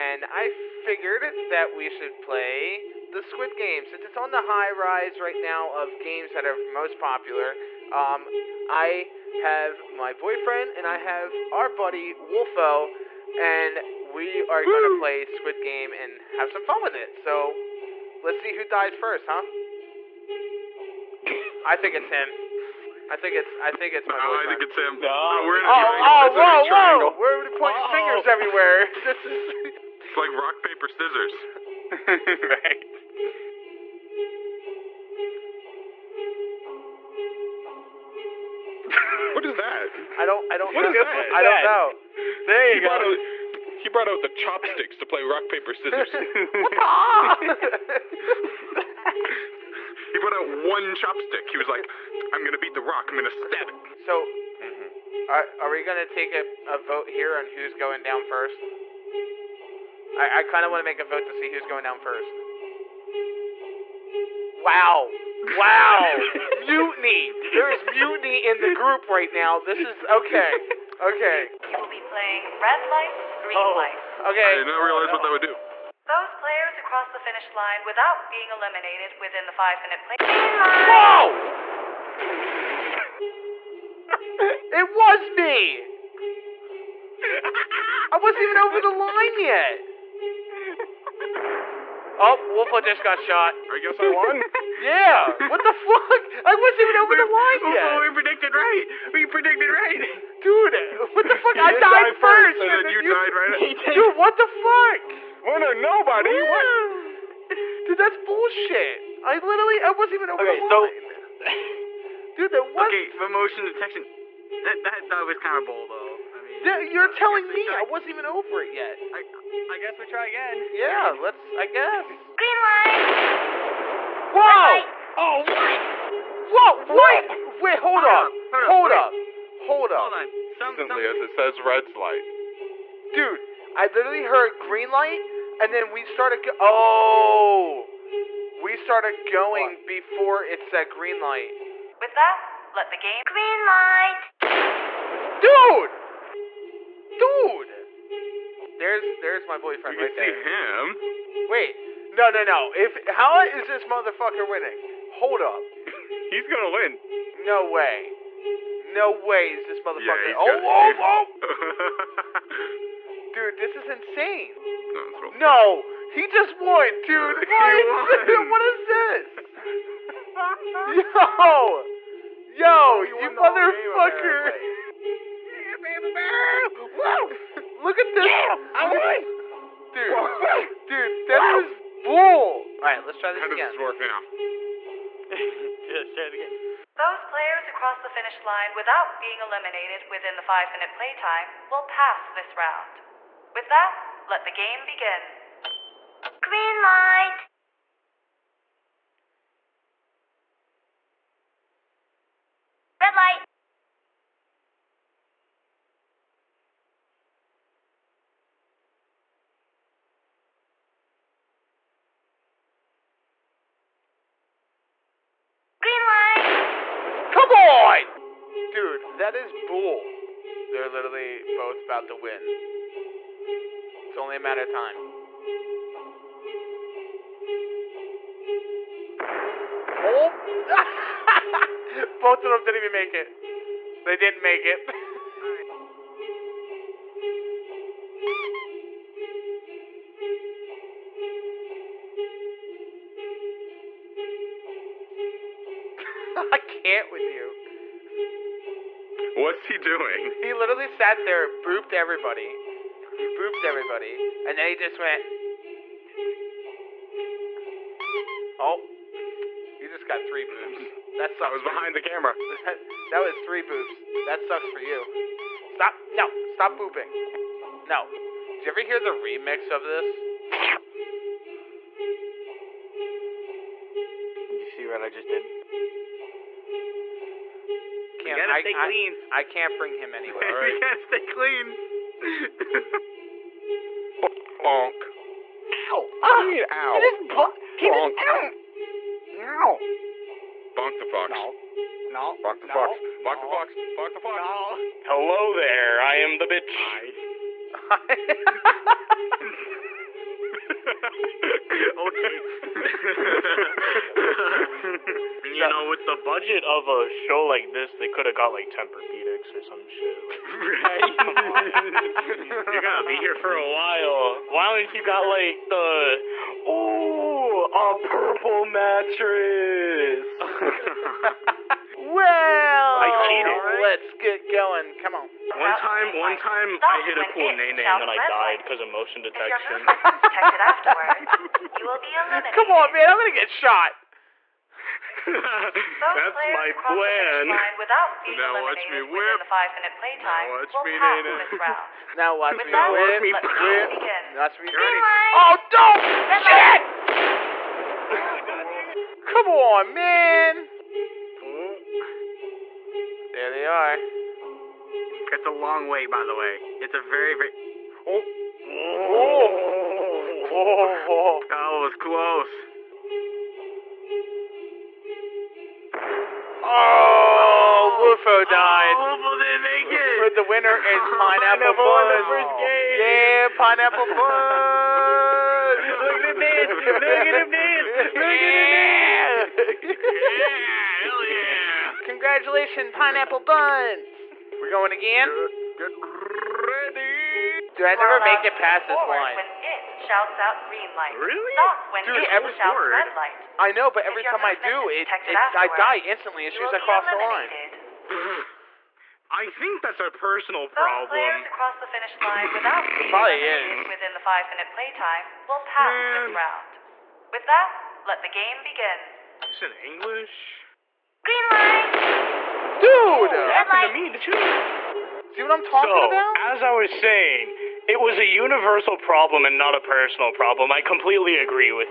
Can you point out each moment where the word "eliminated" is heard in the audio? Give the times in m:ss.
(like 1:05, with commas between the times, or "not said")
1:18, 3:09.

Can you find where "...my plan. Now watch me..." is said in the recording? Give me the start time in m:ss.
5:36.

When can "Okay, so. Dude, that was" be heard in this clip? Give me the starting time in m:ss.
1:50.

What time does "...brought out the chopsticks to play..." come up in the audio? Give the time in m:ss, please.
0:43.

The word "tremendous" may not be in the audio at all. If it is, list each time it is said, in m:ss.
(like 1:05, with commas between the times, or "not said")
not said.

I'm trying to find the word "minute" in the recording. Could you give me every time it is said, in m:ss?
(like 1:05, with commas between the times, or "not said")
1:19, 3:10, 6:44.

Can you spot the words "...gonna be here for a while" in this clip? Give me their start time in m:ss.
5:12.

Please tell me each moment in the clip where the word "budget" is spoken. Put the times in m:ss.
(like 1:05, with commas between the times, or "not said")
5:06.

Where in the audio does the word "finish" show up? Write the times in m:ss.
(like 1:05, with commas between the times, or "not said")
1:17, 3:08, 6:41.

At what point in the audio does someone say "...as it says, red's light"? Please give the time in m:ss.
2:11.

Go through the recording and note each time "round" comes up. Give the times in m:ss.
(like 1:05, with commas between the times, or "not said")
3:12, 6:46.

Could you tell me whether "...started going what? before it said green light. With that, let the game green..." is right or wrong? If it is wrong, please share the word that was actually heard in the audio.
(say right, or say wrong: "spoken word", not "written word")
right.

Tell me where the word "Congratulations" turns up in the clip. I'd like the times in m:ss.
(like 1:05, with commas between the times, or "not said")
6:22.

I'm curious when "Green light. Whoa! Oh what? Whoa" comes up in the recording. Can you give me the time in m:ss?
2:02.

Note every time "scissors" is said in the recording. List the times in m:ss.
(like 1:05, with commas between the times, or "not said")
0:30, 0:45.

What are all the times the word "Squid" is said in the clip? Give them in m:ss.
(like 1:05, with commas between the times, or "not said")
0:03, 0:15.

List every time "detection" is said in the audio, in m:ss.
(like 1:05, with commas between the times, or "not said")
1:53, 5:29.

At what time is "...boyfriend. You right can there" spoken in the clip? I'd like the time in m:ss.
2:29.